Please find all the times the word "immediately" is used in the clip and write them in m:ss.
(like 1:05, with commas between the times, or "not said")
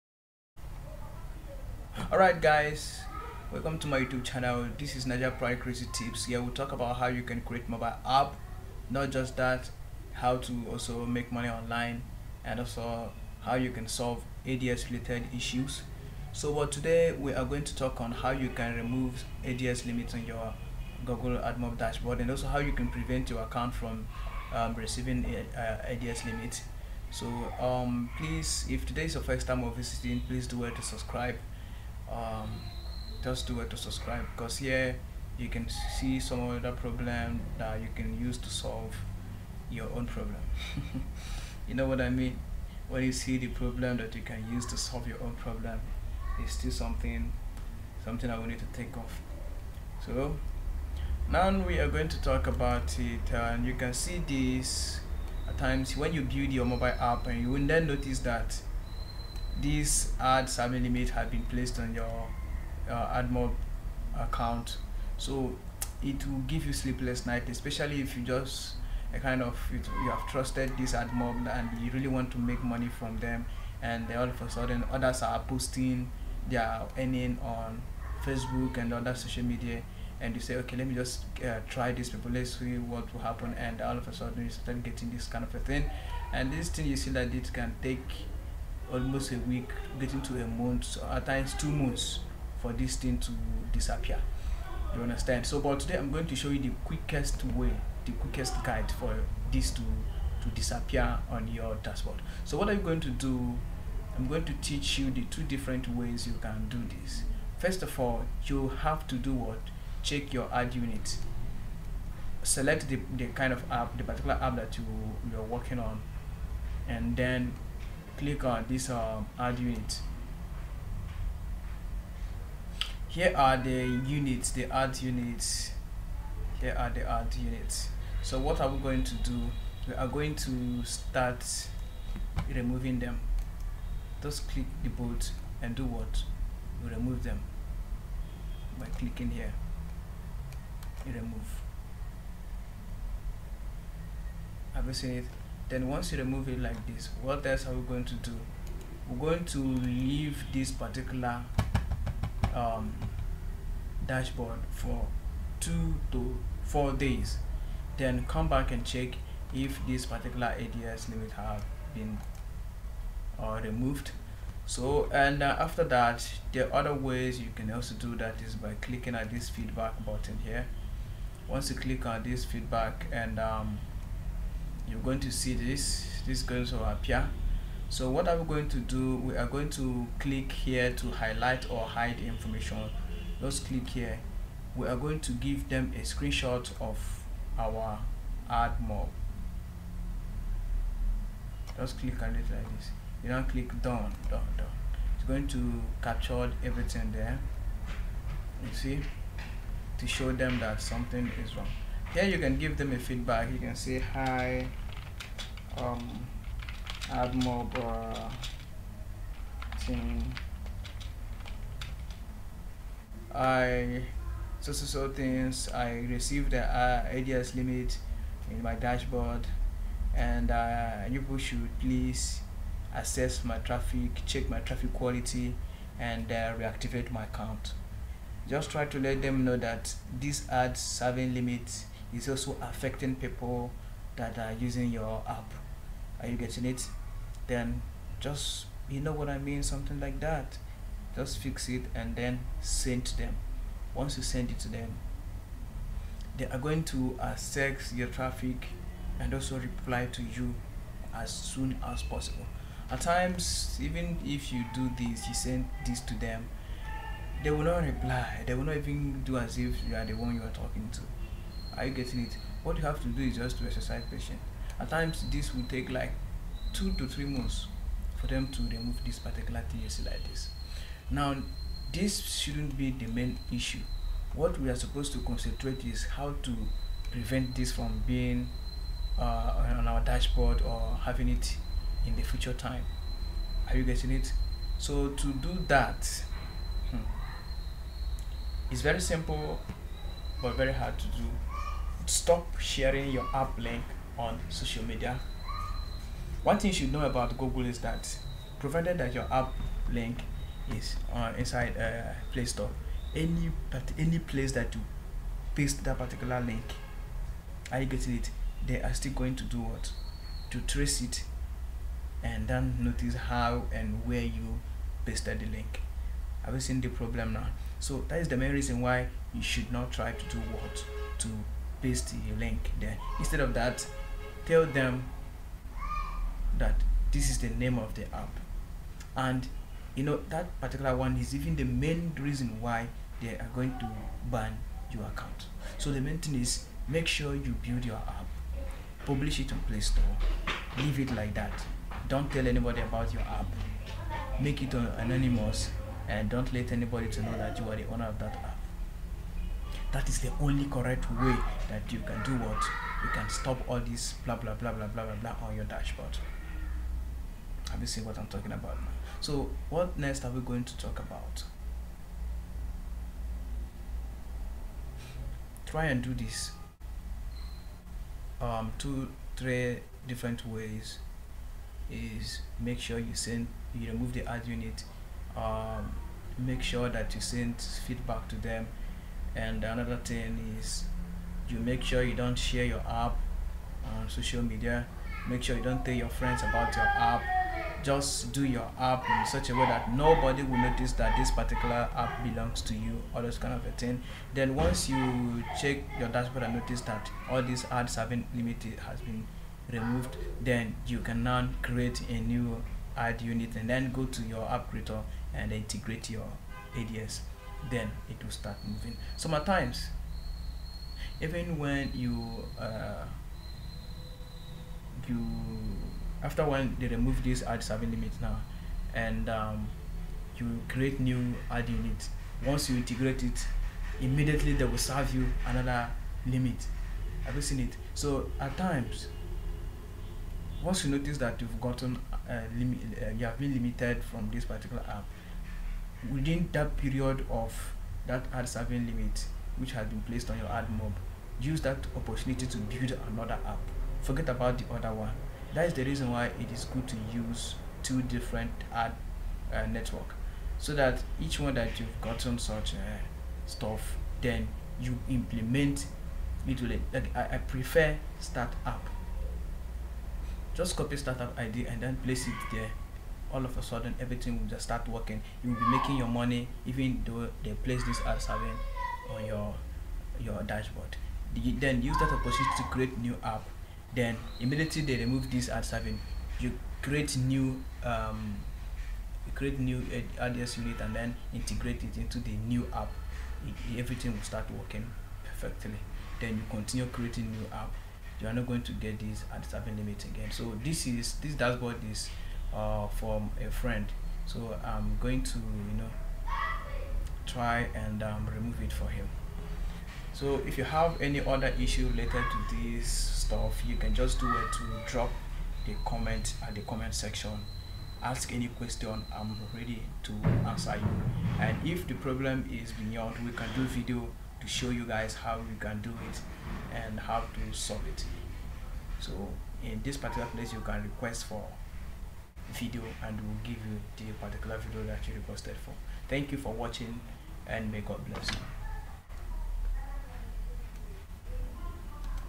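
7:04, 7:54.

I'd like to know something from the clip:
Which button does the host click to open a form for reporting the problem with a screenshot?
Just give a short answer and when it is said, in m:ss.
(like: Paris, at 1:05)
Feedback button, at 2:49.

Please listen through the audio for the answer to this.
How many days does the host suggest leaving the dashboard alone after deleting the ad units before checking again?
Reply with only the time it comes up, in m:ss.
2:35.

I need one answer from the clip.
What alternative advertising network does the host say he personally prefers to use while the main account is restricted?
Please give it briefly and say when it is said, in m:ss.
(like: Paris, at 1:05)
StartApp, at 7:38.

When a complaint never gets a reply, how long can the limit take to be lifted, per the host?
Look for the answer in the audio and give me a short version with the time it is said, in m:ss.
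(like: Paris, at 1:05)
2 to 3 months, at 4:26.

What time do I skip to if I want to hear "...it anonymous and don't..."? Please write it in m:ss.
5:44.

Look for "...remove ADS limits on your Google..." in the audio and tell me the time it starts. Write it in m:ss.
0:18.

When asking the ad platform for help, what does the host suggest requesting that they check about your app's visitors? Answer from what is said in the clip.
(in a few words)
Traffic quality.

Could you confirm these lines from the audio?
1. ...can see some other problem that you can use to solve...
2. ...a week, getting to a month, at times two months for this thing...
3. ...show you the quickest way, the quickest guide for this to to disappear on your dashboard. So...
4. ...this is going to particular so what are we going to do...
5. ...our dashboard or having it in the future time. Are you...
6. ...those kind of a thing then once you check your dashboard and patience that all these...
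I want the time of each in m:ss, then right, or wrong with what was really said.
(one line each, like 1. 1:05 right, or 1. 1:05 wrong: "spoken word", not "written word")
1. 0:35 right
2. 1:29 right
3. 1:36 right
4. 2:56 wrong: "appear", not "particular"
5. 4:39 right
6. 6:33 wrong: "notice", not "patience".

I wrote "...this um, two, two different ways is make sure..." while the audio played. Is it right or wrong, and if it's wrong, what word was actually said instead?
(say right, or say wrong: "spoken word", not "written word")
wrong: "three", not "two".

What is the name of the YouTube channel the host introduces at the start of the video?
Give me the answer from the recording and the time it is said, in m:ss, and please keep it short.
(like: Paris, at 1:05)
Naija Pride Crazy Tips, at 0:05.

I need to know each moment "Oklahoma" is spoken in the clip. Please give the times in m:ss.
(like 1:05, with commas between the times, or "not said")
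not said.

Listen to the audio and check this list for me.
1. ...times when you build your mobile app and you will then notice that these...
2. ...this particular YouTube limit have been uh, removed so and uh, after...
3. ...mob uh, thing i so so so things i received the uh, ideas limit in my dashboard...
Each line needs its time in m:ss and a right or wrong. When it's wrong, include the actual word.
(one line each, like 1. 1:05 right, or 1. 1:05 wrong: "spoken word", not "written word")
1. 0:55 right
2. 2:39 wrong: "ADS", not "YouTube"
3. 3:27 right.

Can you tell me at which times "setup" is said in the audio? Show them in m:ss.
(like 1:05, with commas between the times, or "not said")
not said.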